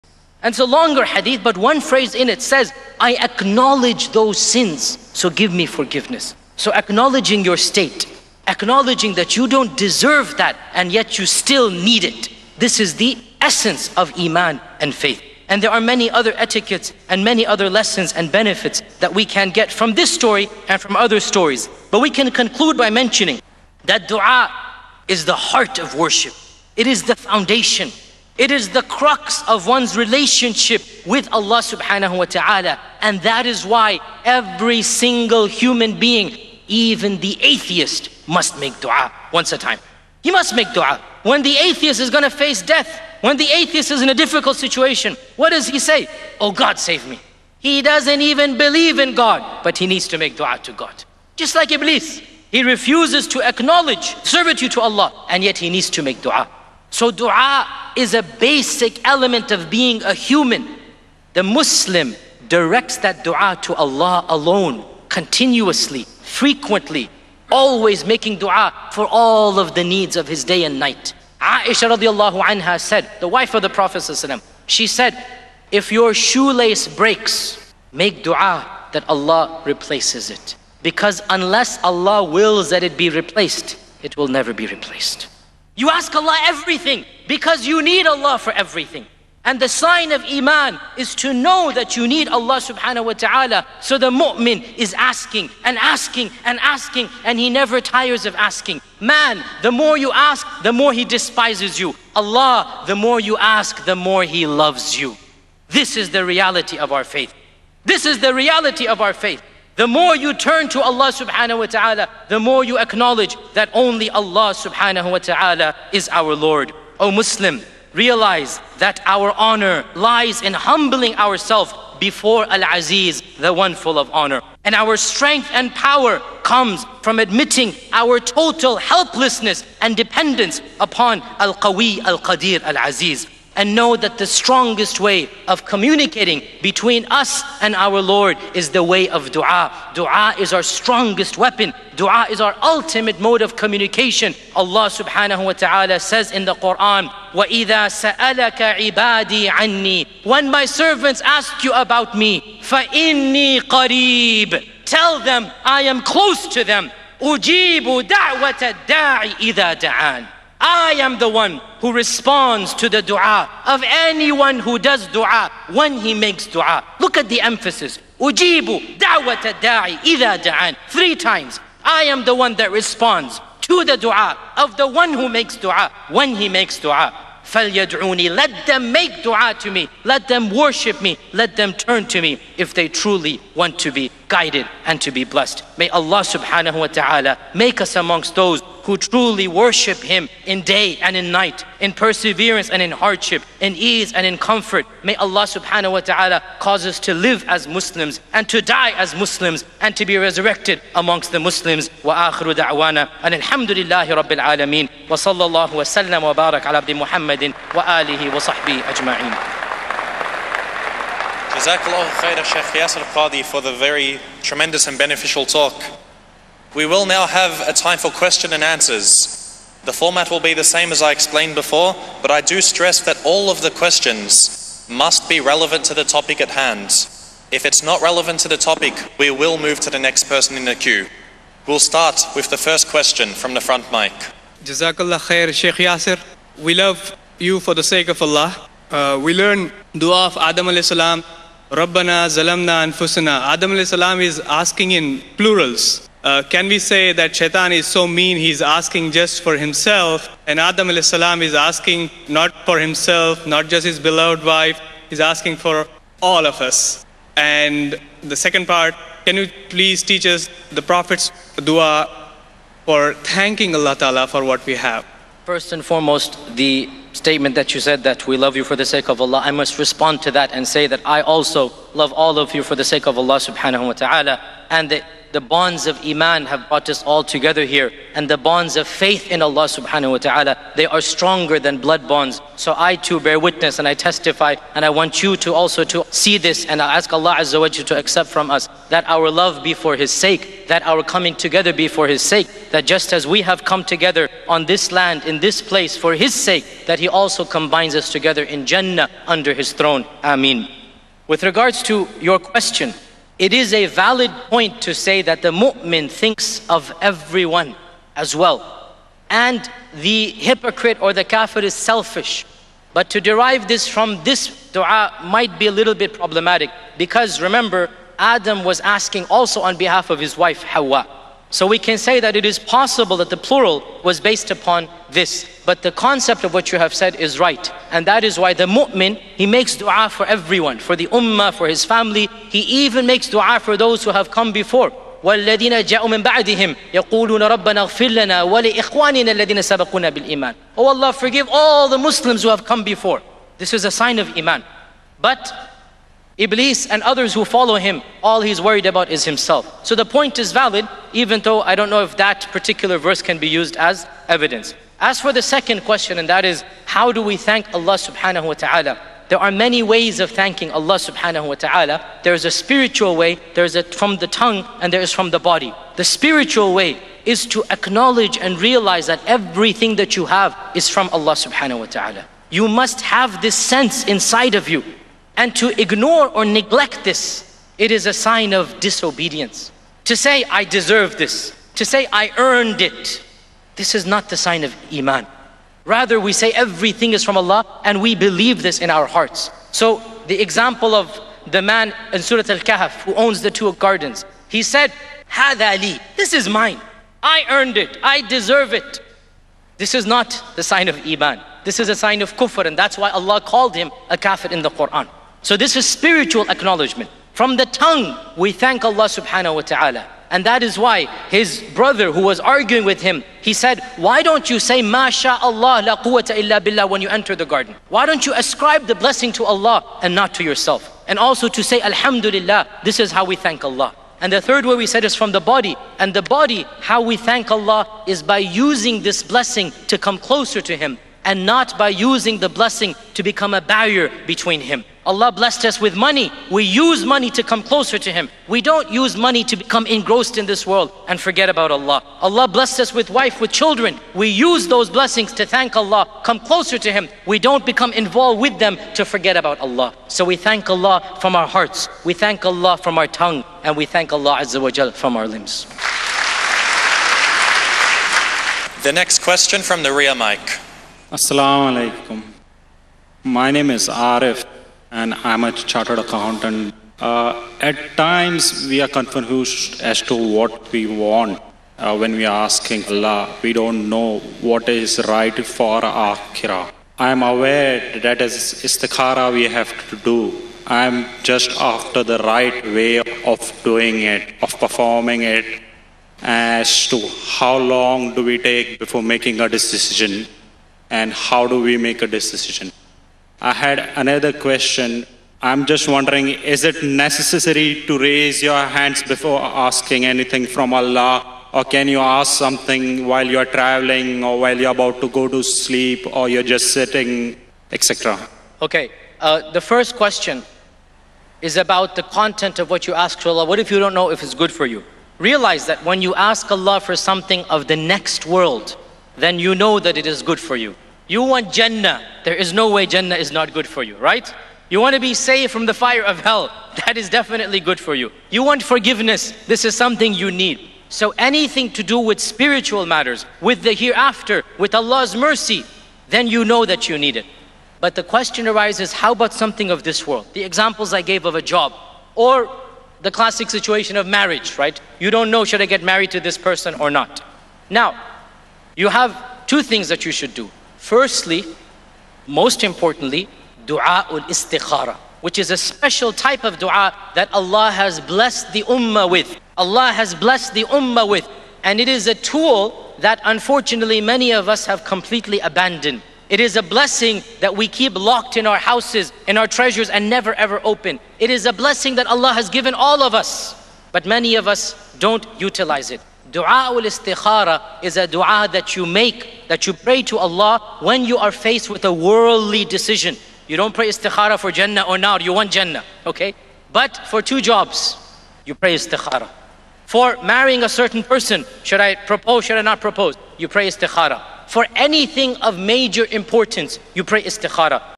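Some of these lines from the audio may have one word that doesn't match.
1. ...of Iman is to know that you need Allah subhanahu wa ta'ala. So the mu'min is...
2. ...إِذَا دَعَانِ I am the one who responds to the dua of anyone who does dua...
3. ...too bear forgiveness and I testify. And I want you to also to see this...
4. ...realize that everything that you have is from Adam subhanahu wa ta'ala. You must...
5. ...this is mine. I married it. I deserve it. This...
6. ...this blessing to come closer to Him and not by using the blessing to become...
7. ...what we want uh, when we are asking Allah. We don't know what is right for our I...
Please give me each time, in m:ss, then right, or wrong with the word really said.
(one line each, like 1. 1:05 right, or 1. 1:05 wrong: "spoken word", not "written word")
1. 1:30 right
2. 2:39 right
3. 4:42 wrong: "witness", not "forgiveness"
4. 6:08 wrong: "Allah", not "Adam"
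5. 6:36 wrong: "earned", not "married"
6. 7:09 right
7. 7:50 right.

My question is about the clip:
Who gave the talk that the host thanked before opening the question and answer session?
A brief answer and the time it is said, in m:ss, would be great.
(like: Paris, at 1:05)
Sheikh Yasir Qadhi, at 3:32.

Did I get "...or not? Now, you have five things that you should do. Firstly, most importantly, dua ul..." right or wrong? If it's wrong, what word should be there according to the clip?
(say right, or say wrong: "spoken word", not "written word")
wrong: "two", not "five".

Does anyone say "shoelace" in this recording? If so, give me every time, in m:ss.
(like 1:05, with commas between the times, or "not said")
1:16.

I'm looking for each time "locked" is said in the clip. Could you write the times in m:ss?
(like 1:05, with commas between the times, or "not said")
9:27.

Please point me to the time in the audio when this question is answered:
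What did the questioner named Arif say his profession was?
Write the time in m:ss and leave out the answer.
7:45.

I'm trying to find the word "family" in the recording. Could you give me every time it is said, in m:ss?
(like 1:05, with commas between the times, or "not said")
5:31.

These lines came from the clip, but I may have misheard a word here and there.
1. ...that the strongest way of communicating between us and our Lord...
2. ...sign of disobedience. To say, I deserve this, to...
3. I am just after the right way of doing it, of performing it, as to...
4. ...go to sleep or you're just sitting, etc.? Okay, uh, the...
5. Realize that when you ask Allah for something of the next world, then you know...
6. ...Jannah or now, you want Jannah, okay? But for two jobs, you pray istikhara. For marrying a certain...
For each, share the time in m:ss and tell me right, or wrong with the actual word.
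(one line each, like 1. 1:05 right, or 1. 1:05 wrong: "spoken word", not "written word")
1. 2:13 right
2. 6:18 right
3. 8:00 right
4. 8:25 right
5. 8:35 right
6. 9:44 right.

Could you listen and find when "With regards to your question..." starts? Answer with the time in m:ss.
5:01.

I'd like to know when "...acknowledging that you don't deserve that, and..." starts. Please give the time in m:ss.
0:08.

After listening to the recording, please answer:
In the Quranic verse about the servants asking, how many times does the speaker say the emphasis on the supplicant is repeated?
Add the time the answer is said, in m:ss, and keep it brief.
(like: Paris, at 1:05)
3, at 2:50.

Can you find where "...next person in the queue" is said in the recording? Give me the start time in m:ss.
3:49.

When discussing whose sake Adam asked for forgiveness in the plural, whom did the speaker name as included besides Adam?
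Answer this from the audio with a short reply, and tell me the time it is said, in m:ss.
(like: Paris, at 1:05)
Hawa, at 5:20.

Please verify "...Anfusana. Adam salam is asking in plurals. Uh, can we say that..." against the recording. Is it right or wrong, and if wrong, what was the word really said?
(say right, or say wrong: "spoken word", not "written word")
right.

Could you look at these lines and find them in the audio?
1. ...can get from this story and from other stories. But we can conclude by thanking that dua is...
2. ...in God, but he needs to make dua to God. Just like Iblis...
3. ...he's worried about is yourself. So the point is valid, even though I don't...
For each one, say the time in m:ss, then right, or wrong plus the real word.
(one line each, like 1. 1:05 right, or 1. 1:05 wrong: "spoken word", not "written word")
1. 0:19 wrong: "mentioning", not "thanking"
2. 0:48 right
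3. 5:48 wrong: "himself", not "yourself".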